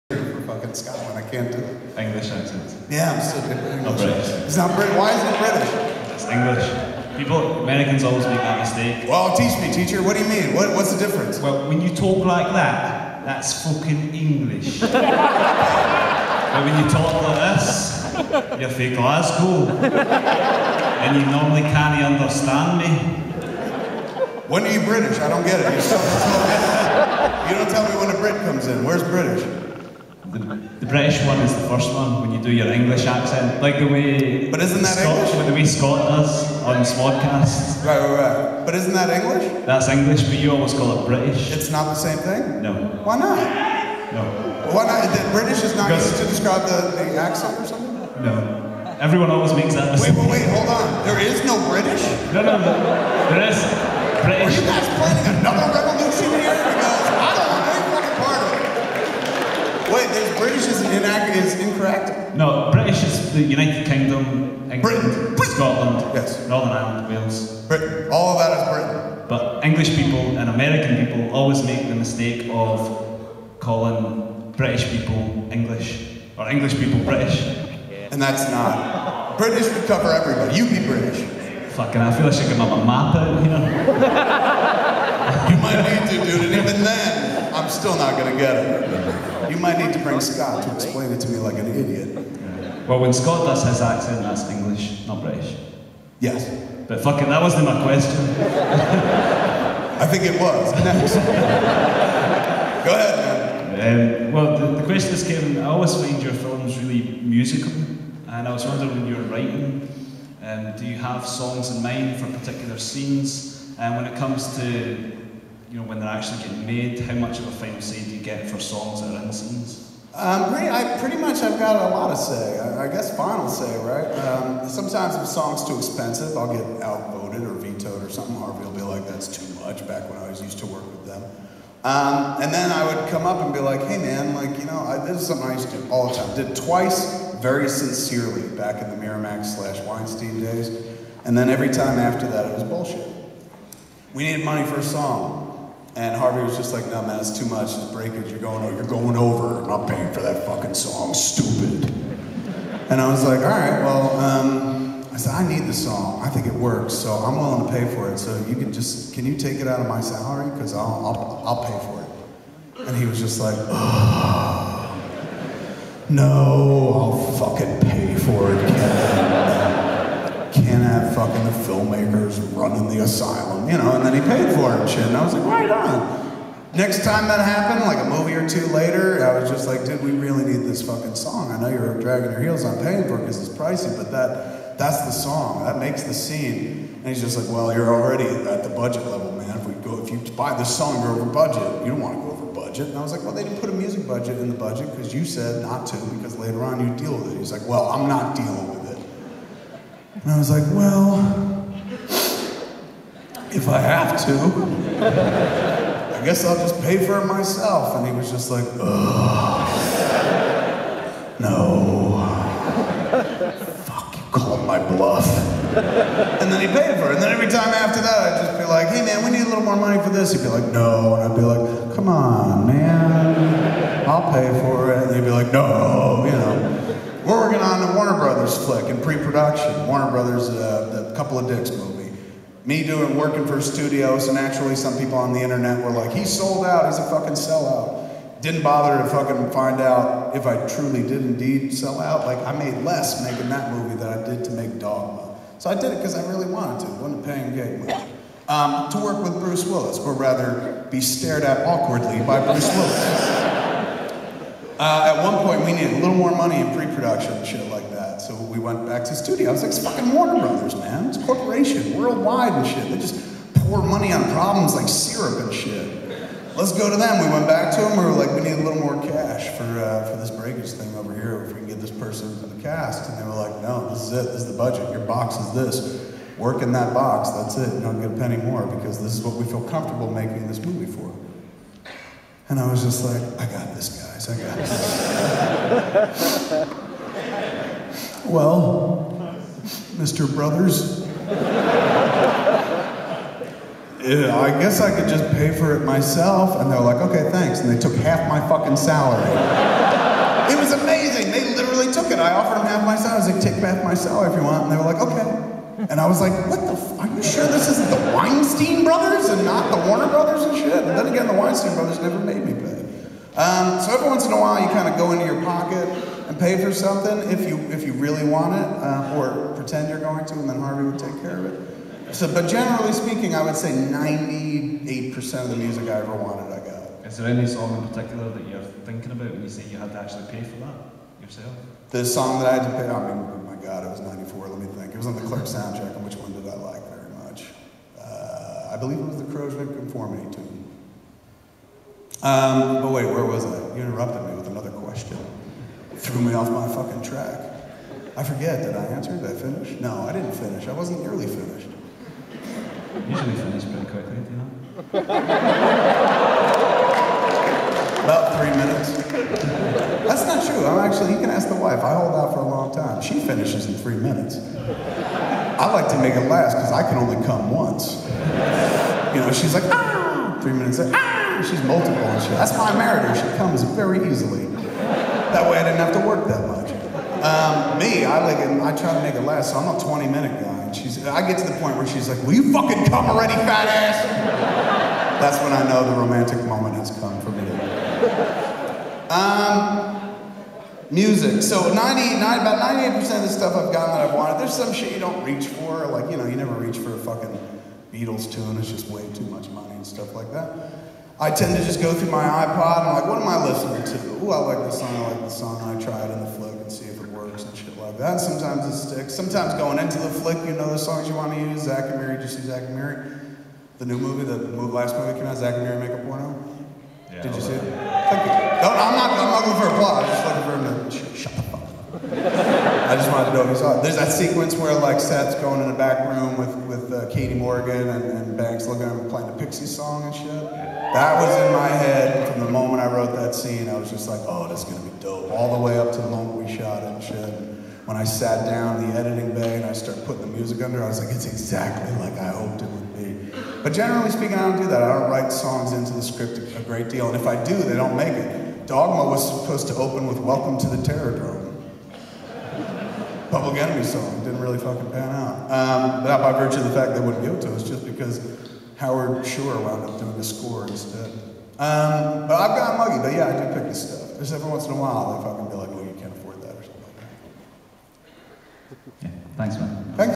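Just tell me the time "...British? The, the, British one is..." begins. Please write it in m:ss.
0:29.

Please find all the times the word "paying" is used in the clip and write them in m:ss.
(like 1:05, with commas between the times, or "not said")
2:29, 3:02, 4:07.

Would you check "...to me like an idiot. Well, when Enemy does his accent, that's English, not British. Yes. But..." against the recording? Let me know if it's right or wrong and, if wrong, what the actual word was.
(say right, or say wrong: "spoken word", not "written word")
wrong: "Scott", not "Enemy".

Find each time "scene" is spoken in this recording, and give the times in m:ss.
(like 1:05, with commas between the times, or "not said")
1:52, 3:06, 7:13.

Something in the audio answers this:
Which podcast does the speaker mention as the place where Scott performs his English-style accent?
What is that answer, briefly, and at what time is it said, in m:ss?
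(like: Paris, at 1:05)
SModcast, at 0:36.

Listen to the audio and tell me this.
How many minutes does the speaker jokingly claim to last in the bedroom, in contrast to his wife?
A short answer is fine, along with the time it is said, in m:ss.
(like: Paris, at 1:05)
20, at 6:19.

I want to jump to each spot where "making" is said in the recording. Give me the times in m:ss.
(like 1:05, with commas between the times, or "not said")
4:03, 4:40.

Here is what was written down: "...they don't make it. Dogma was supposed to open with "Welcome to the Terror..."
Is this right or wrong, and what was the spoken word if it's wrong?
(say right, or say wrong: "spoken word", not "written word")
right.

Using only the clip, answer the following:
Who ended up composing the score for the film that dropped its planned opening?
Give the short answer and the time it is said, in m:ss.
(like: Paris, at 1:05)
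Howard Shore, at 7:38.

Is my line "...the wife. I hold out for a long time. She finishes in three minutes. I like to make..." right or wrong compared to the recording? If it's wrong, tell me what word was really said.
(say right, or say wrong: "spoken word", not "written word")
right.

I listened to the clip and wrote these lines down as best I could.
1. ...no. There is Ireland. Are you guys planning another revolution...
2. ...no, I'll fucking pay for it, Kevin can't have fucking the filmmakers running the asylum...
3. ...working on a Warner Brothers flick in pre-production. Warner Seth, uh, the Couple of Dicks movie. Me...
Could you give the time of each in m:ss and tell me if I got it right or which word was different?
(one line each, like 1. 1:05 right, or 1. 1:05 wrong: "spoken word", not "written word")
1. 0:52 wrong: "British", not "Ireland"
2. 2:46 right
3. 3:47 wrong: "Brothers", not "Seth".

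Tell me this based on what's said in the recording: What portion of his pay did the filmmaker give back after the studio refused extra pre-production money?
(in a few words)
Half my salary.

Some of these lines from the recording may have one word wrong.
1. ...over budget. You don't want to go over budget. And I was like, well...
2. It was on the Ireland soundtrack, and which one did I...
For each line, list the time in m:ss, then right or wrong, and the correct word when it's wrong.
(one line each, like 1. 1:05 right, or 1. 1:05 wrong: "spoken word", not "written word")
1. 3:11 right
2. 5:34 wrong: "Clerks", not "Ireland".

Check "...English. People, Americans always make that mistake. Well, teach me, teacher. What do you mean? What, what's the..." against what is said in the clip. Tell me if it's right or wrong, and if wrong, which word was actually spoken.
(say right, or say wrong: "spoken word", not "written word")
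right.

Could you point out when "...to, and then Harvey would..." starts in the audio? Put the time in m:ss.
5:20.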